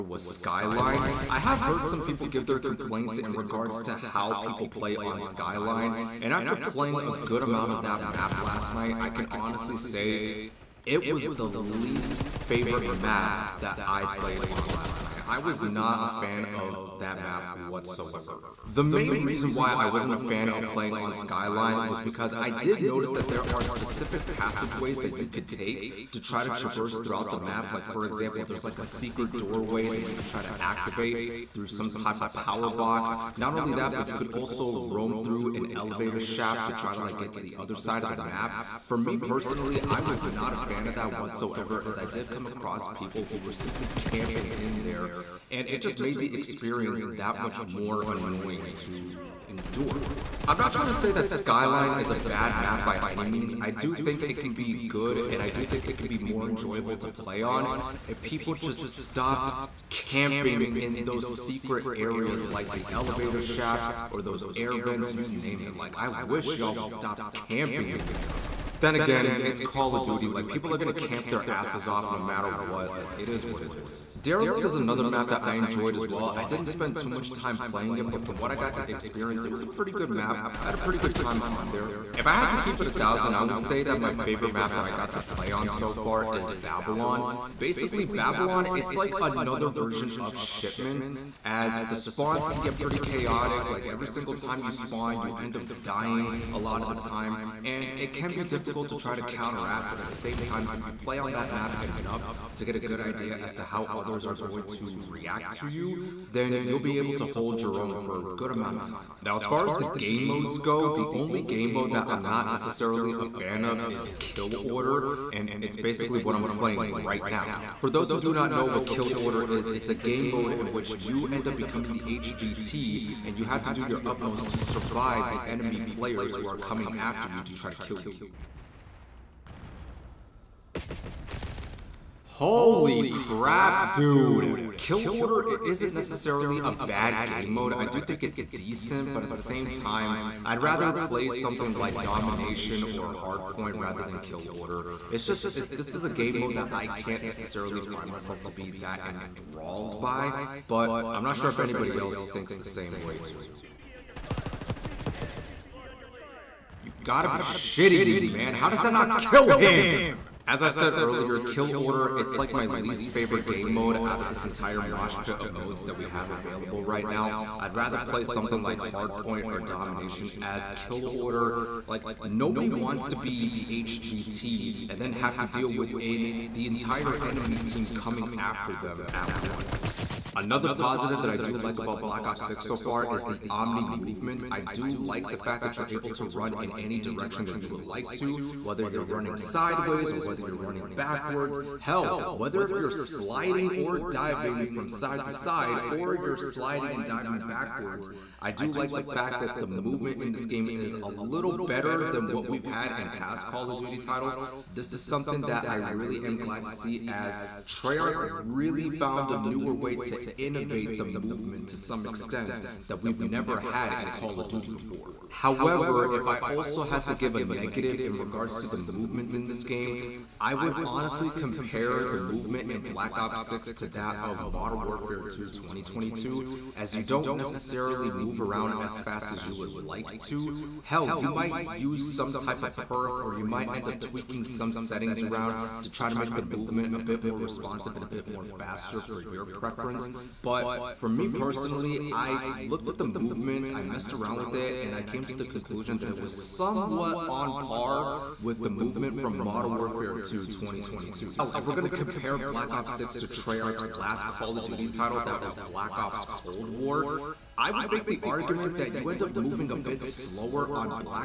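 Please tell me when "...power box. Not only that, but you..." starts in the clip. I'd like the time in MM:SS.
00:32.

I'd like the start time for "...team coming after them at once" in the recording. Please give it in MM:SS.
02:57.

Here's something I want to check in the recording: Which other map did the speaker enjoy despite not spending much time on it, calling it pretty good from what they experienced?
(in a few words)
Derelict.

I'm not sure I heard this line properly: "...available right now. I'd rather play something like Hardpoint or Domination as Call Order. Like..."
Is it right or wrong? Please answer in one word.
wrong.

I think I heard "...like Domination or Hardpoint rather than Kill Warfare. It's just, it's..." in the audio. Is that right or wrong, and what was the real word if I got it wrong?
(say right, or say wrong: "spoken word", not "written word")
wrong: "Order", not "Warfare".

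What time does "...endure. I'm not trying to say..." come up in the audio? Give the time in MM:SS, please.
00:49.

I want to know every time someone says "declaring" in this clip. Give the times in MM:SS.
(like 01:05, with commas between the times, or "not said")
not said.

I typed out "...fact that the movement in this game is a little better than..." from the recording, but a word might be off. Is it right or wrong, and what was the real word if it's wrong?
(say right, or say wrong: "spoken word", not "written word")
right.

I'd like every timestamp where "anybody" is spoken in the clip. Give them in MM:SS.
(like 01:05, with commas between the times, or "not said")
02:31.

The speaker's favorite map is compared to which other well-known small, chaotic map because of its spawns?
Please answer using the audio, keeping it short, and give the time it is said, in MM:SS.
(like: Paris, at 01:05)
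Shipment, at 01:30.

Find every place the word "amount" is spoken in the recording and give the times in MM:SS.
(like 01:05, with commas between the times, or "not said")
00:07, 01:48.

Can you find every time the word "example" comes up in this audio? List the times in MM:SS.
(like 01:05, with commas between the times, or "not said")
00:28.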